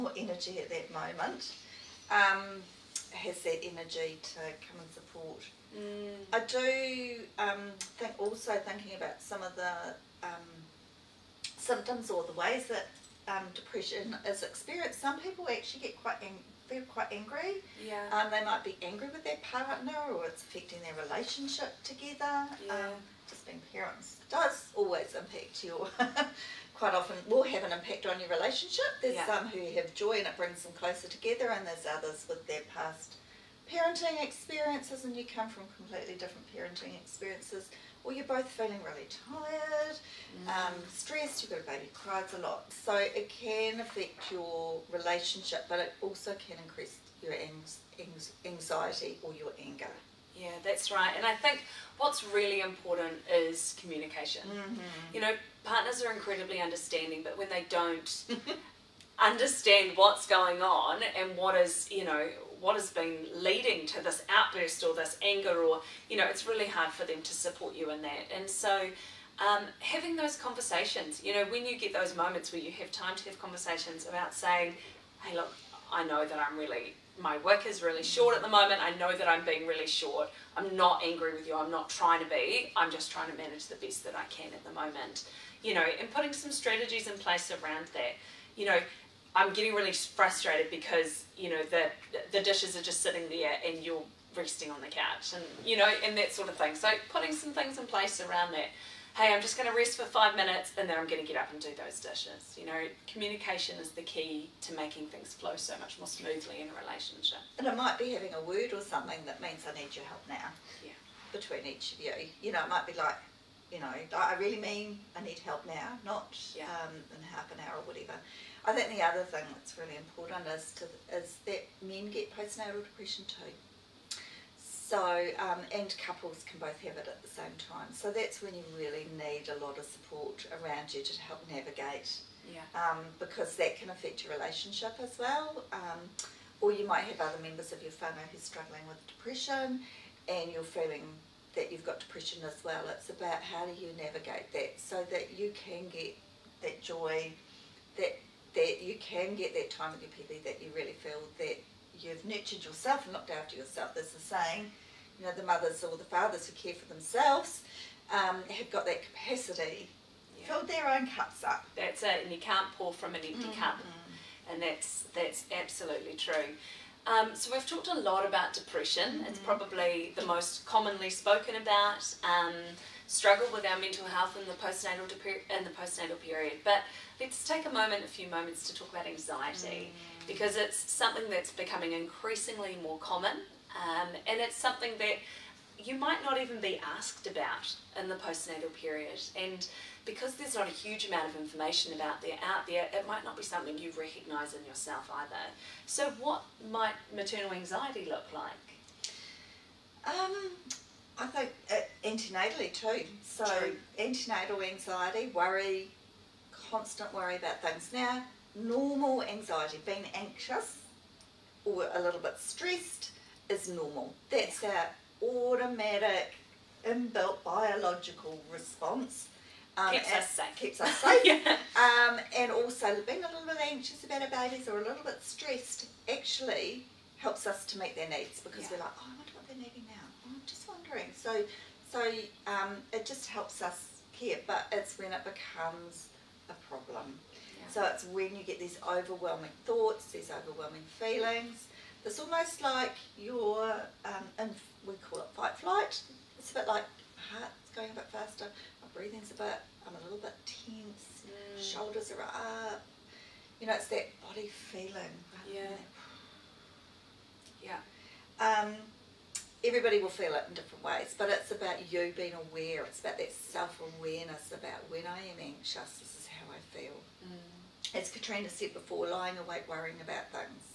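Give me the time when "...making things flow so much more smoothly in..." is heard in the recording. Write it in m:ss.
1:44.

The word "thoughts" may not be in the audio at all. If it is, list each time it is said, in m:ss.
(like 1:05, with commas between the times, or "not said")
3:59.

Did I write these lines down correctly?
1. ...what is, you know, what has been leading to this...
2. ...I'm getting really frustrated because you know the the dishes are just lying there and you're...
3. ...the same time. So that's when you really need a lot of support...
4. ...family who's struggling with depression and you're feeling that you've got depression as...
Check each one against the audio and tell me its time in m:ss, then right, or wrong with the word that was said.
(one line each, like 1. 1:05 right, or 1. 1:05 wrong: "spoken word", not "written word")
1. 1:01 right
2. 1:29 wrong: "sitting", not "lying"
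3. 2:07 right
4. 2:17 right.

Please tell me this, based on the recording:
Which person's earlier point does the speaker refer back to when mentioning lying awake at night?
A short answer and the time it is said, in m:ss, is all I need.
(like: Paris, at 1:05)
Kartina, at 4:28.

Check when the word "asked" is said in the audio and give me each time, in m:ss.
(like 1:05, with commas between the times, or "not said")
3:06.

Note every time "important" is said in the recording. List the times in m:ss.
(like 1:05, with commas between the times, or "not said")
0:52, 1:59.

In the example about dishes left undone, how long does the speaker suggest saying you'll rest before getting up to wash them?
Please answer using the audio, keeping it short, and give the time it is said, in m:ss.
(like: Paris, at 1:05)
5 minutes, at 1:40.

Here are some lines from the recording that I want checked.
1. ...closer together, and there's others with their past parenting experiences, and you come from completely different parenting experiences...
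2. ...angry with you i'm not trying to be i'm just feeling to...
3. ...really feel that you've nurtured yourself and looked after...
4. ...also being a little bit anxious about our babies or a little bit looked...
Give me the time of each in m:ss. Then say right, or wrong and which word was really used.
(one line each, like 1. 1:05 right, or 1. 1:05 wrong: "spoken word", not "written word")
1. 0:30 right
2. 1:21 wrong: "trying", not "feeling"
3. 2:30 right
4. 3:42 wrong: "stressed", not "looked".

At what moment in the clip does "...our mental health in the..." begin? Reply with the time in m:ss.
2:53.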